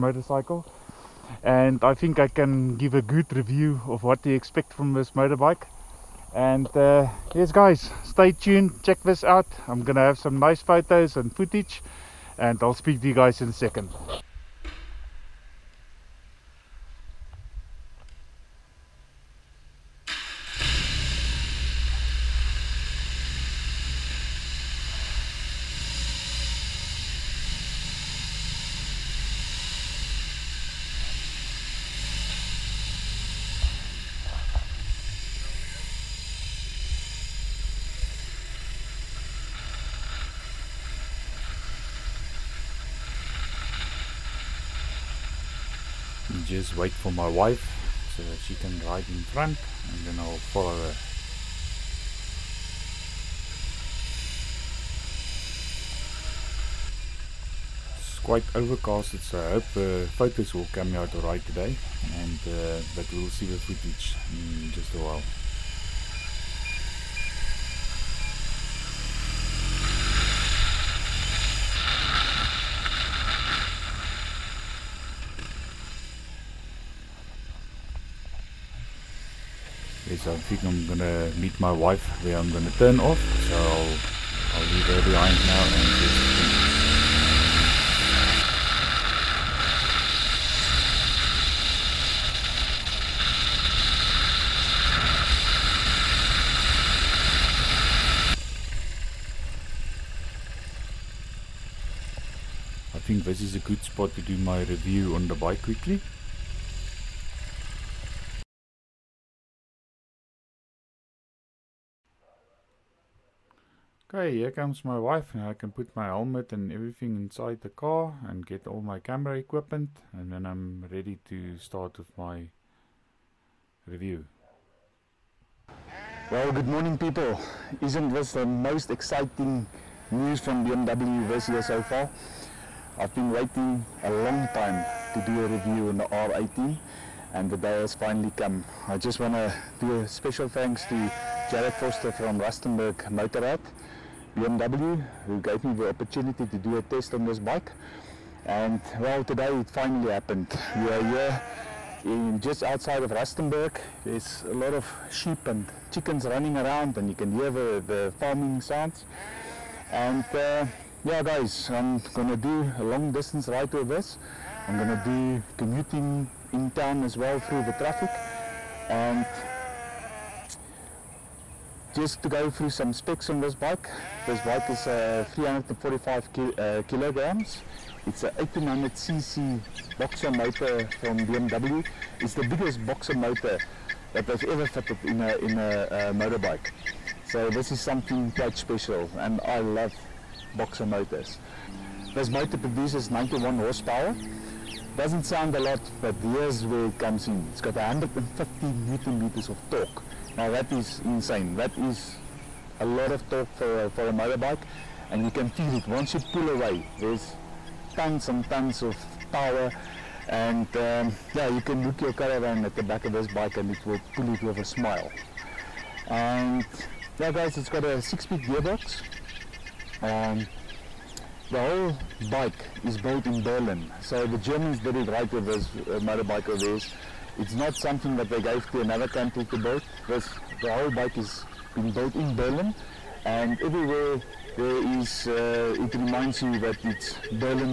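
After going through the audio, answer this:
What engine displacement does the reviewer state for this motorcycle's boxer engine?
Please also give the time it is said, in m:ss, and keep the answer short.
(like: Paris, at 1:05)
1800cc, at 2:58.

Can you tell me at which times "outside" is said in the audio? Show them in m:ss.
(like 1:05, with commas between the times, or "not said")
2:32.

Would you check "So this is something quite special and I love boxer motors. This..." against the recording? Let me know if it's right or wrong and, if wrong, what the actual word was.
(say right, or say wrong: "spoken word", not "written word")
right.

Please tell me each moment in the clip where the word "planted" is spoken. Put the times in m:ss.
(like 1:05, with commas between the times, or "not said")
not said.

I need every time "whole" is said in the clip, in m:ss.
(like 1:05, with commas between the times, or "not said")
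3:41, 3:50.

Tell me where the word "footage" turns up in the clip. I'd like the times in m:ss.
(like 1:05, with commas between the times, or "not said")
0:11, 1:03.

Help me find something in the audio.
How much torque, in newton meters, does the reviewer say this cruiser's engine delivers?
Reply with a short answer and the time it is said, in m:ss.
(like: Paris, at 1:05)
150, at 3:17.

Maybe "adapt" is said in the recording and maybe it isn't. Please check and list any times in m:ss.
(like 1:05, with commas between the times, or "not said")
not said.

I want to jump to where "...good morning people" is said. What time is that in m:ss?
2:06.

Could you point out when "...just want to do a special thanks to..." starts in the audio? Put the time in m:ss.
2:18.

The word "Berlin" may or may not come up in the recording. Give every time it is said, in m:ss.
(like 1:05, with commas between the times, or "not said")
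3:43, 3:52.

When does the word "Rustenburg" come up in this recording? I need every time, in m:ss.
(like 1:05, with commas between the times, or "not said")
2:22, 2:33.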